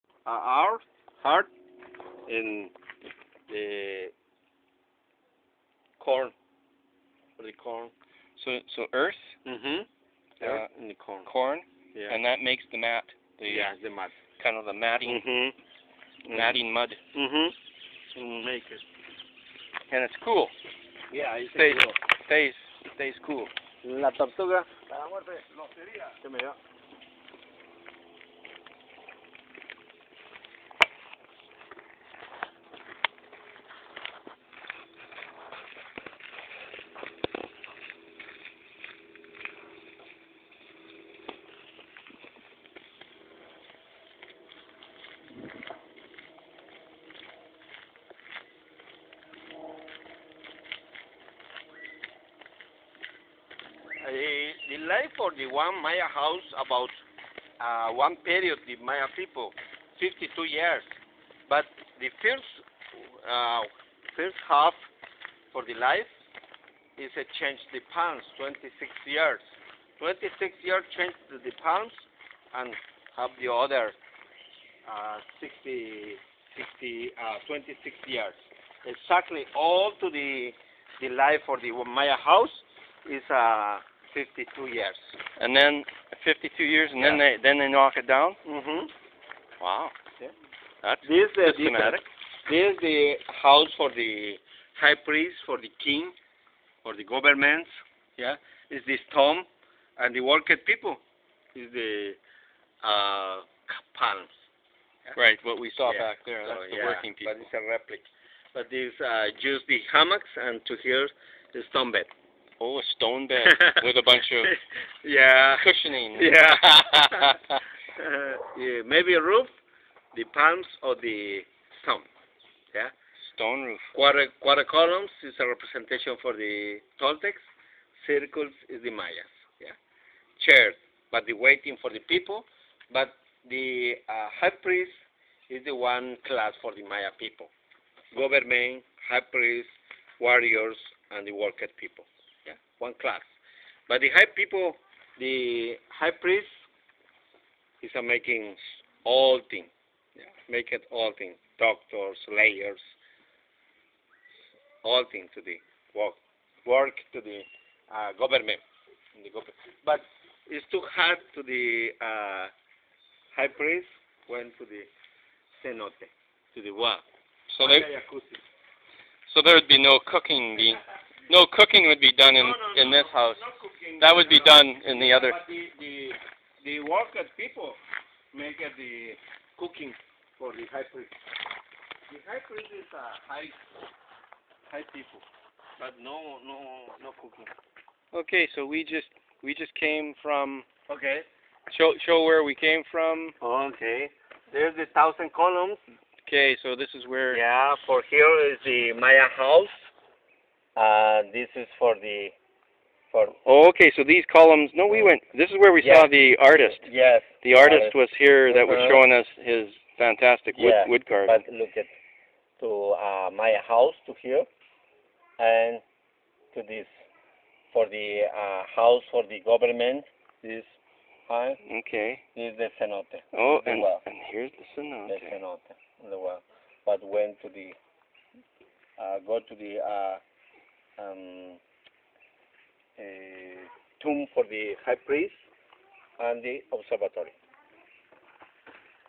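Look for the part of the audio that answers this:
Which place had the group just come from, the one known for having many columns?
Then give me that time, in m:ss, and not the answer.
3:14.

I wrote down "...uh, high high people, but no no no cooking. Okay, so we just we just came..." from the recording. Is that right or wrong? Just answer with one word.
right.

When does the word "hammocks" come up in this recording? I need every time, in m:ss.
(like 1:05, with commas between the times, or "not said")
1:49.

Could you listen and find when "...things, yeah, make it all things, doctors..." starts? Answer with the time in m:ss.
2:29.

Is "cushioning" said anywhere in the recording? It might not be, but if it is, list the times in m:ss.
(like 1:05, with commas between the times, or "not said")
1:55.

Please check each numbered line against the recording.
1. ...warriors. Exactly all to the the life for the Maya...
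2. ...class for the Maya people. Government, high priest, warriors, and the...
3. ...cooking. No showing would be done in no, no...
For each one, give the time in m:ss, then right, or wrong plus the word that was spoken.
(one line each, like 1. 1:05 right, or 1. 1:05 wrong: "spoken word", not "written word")
1. 1:18 wrong: "years", not "warriors"
2. 2:16 right
3. 2:50 wrong: "cooking", not "showing".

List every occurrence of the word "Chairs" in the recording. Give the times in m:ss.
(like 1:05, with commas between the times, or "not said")
2:10.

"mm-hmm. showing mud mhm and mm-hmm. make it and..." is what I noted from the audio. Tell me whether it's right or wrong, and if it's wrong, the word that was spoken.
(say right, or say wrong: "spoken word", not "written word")
wrong: "matting", not "showing".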